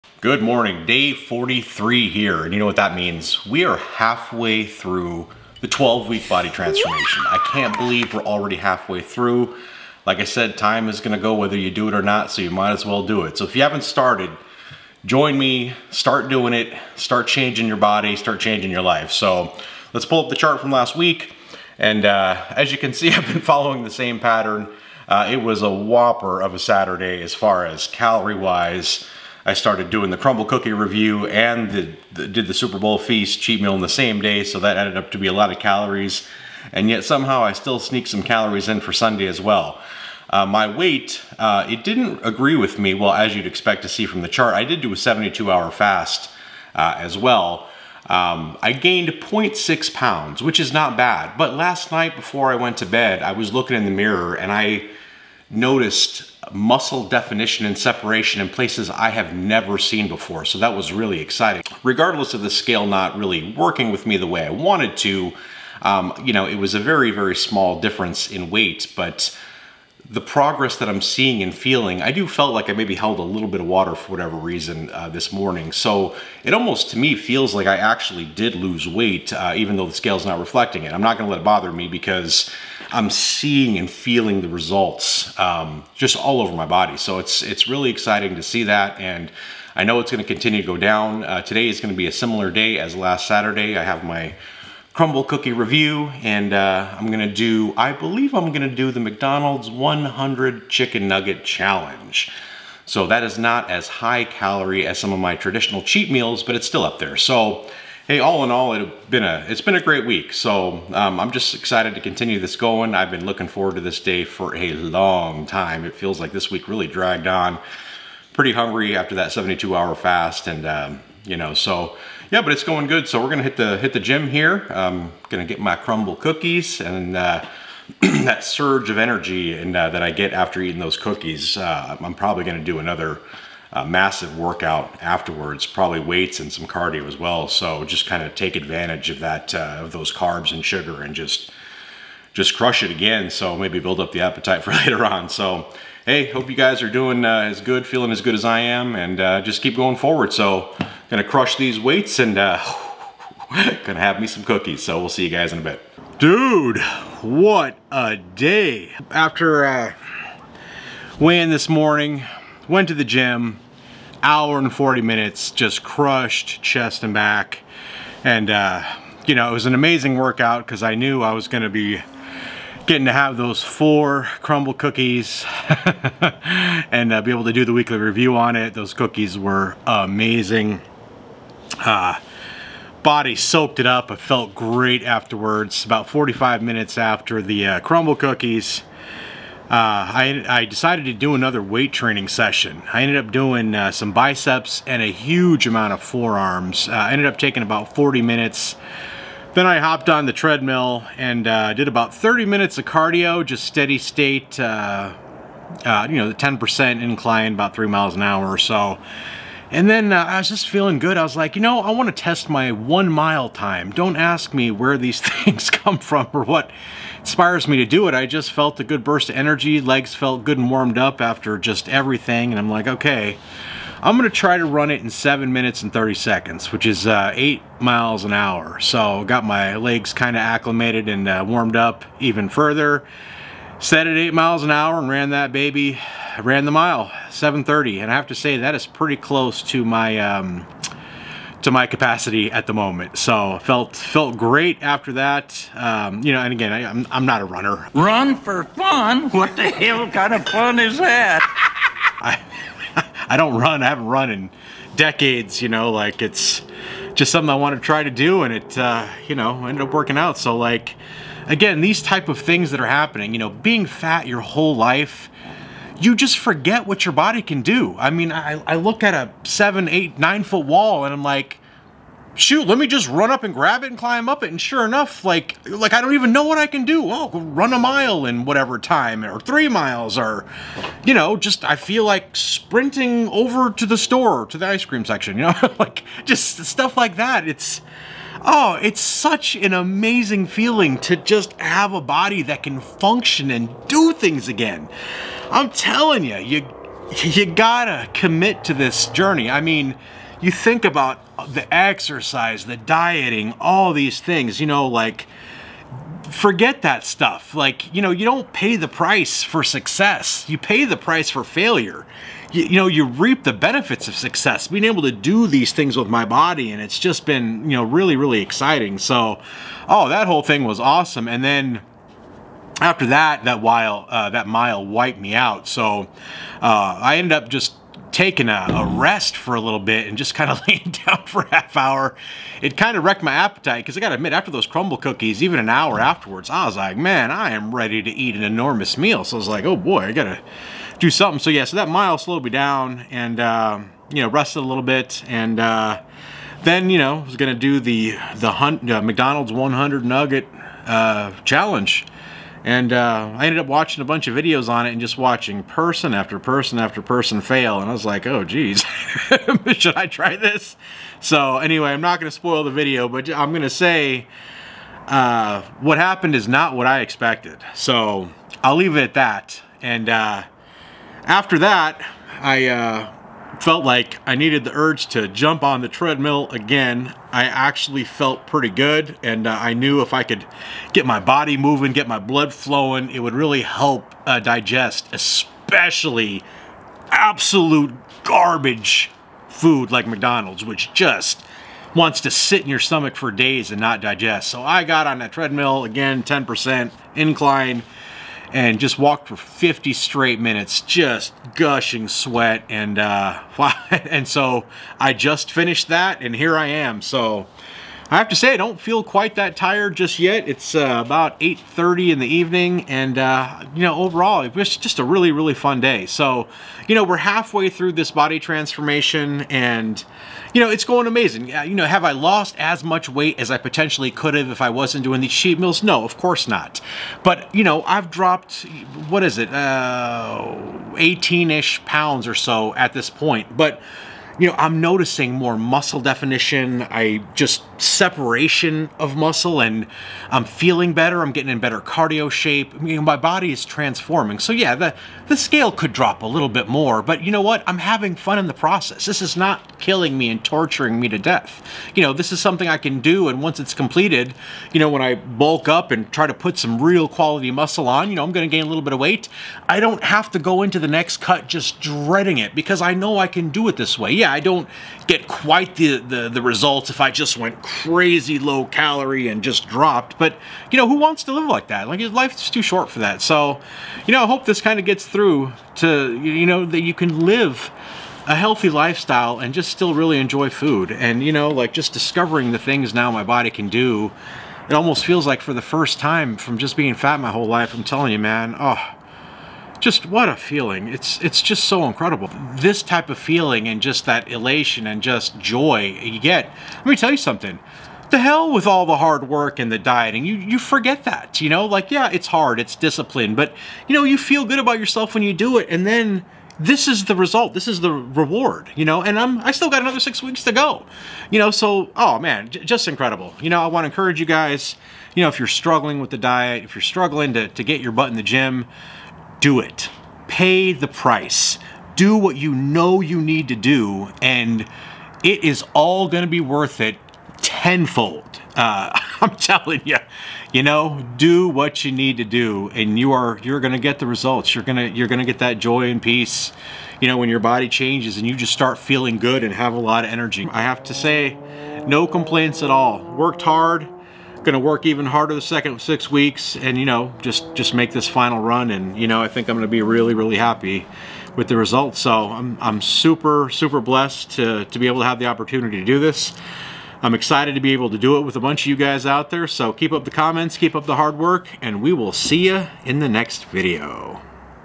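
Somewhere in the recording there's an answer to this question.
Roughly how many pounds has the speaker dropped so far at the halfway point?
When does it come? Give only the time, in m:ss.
7:09.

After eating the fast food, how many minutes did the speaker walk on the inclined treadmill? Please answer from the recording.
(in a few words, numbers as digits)
50 minutes.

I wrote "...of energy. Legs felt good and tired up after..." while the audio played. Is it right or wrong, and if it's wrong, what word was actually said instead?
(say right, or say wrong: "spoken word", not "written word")
wrong: "warmed", not "tired".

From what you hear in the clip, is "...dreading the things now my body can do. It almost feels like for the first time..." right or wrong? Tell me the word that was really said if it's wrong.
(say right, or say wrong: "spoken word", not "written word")
wrong: "discovering", not "dreading".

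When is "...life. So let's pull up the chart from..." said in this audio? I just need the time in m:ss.
0:18.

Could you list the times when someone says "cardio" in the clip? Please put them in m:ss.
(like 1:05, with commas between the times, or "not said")
2:16, 3:22, 7:21.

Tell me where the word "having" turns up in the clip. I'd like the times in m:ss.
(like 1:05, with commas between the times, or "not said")
7:27.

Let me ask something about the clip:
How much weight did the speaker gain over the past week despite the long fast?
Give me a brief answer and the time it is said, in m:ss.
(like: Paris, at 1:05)
0.6 pounds, at 0:49.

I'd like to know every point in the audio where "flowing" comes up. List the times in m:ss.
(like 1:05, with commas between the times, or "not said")
6:22.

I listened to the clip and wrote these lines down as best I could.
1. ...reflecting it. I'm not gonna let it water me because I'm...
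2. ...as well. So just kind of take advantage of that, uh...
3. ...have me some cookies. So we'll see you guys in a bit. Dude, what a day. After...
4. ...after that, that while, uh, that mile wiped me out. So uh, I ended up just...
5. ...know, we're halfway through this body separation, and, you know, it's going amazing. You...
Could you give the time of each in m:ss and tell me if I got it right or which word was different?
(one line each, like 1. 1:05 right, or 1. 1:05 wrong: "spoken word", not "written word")
1. 1:20 wrong: "bother", not "water"
2. 2:17 right
3. 2:34 right
4. 5:22 right
5. 6:56 wrong: "transformation", not "separation".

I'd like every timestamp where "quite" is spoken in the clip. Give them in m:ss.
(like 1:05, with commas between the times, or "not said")
6:49, 7:45.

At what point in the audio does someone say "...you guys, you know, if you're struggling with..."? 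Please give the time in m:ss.
8:34.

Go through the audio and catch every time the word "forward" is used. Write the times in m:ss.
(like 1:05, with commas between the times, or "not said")
1:53, 2:29.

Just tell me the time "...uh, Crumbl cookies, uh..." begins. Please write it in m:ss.
3:07.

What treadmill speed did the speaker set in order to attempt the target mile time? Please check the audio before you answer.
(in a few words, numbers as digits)
8 miles an hour.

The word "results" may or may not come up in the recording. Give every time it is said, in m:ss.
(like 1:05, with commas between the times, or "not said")
1:24, 7:46, 8:27, 8:54, 9:11.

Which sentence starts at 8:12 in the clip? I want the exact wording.
This type of feeling and just that elation and just joy you get.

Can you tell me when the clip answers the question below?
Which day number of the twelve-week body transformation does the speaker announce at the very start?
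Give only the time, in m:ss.
0:00.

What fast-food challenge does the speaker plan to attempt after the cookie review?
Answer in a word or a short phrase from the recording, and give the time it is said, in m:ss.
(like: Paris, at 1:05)
McDonald's 100 chicken nugget challenge, at 1:38.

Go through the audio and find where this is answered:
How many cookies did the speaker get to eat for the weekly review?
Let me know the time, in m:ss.
2:53.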